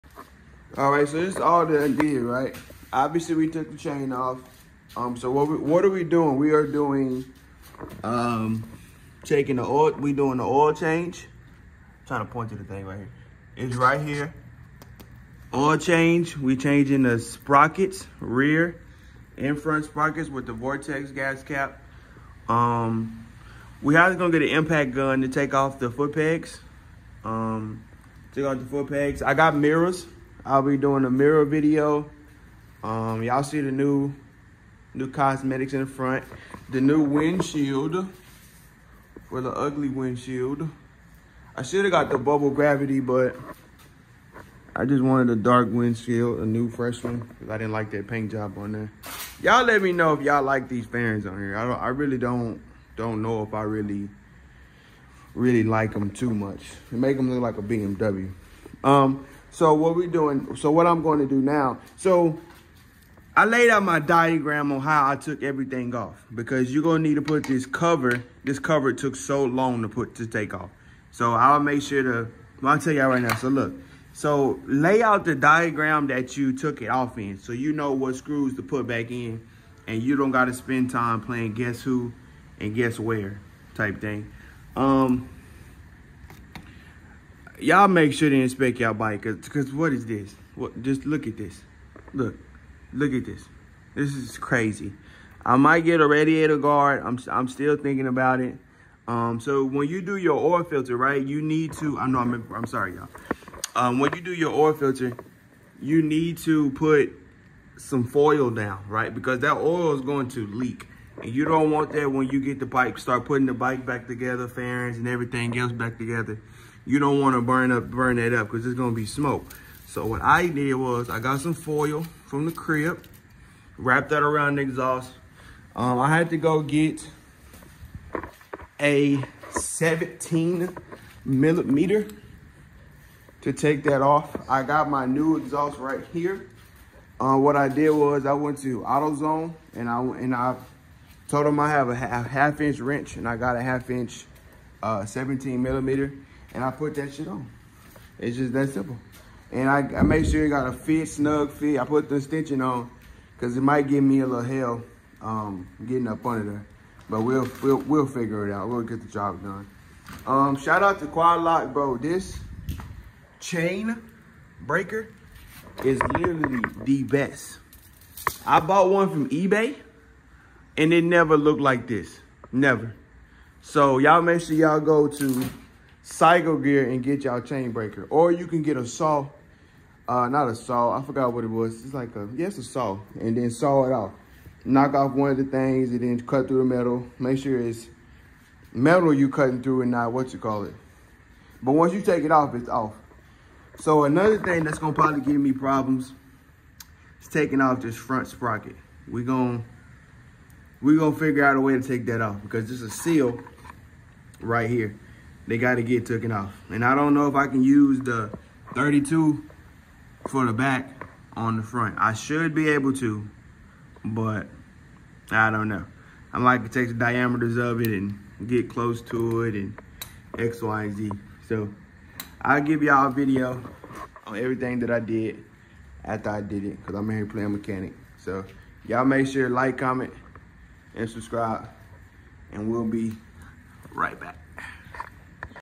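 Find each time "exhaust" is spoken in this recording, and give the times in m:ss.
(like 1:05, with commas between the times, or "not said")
2:04, 2:15.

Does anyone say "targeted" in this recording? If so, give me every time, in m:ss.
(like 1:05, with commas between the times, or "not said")
not said.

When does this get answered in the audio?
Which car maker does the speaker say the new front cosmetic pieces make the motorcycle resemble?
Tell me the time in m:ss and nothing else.
0:57.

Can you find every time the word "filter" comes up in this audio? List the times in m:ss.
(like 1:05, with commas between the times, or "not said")
1:40, 1:44.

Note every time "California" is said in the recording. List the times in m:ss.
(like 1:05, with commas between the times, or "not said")
not said.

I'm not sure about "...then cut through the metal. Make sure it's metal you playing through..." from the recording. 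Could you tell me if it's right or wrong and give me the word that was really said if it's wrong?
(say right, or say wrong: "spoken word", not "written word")
wrong: "cutting", not "playing".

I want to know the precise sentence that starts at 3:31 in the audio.
I should be able to, but I don't know.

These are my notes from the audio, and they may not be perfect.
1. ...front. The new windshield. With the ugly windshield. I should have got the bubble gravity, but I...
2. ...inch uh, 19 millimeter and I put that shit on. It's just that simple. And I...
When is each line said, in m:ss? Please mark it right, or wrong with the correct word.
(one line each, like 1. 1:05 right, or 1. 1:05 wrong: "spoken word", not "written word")
1. 0:35 right
2. 2:23 wrong: "17", not "19".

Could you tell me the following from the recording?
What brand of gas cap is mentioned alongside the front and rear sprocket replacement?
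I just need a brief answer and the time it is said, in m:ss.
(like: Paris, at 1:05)
Vortex, at 0:20.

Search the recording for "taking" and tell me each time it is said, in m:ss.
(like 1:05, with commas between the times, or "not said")
0:09, 3:17.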